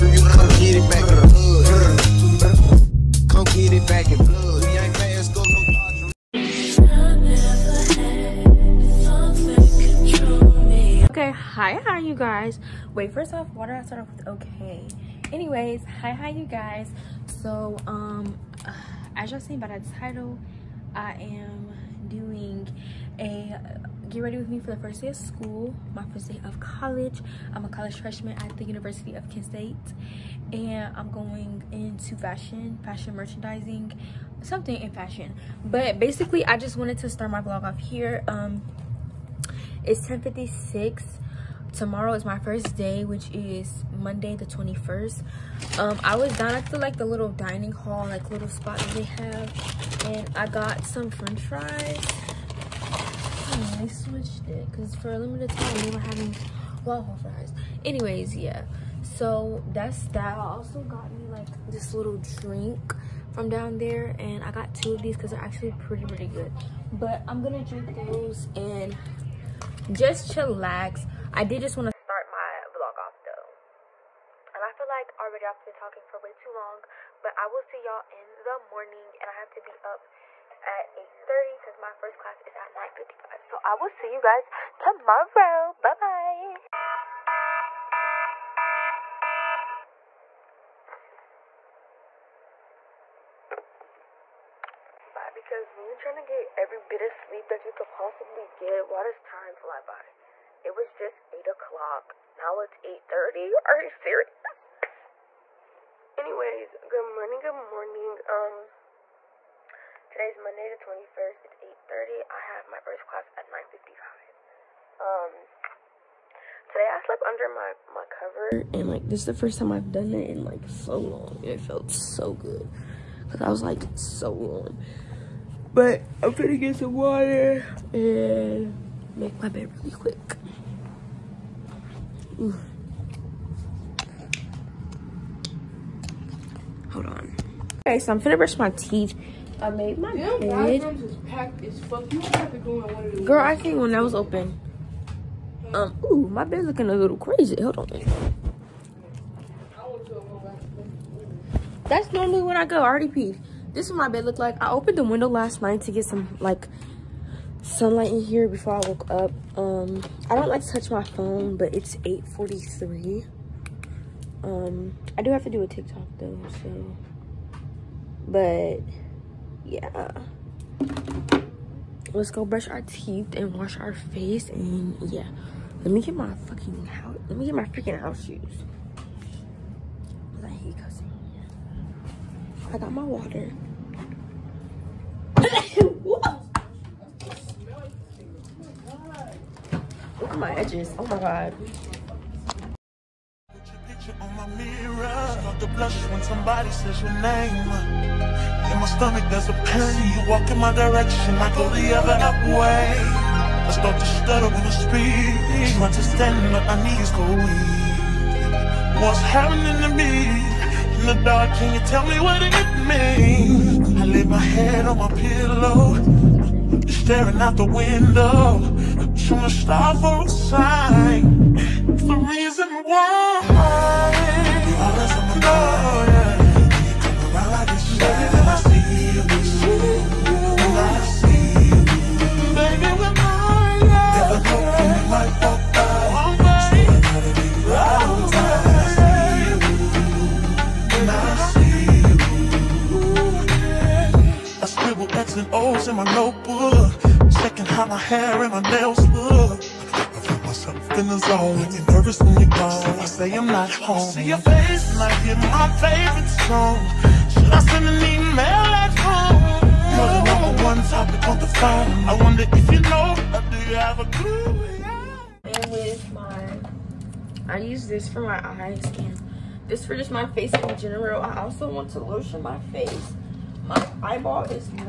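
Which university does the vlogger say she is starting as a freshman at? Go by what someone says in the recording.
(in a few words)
Kent State.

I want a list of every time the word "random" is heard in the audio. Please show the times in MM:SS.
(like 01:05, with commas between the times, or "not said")
not said.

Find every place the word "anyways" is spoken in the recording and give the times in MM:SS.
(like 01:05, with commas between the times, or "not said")
00:15, 00:57, 01:46.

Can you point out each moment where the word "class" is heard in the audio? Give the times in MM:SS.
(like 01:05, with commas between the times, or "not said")
01:22, 01:53.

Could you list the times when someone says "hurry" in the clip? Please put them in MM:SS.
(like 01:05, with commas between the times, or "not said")
not said.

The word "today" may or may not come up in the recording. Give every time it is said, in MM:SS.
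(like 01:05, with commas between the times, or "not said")
01:50, 01:56.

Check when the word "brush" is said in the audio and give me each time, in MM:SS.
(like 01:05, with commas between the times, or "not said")
02:18, 02:52.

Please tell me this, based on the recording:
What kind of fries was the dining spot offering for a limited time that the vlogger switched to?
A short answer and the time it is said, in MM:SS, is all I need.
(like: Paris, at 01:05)
Waffle fries, at 00:56.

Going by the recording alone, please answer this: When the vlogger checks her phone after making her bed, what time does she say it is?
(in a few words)
8:43.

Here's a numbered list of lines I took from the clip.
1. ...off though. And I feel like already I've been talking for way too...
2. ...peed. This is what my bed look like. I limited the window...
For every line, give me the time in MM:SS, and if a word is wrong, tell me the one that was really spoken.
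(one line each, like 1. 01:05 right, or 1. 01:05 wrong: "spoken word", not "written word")
1. 01:12 right
2. 02:33 wrong: "opened", not "limited".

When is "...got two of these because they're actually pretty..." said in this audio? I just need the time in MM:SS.
01:04.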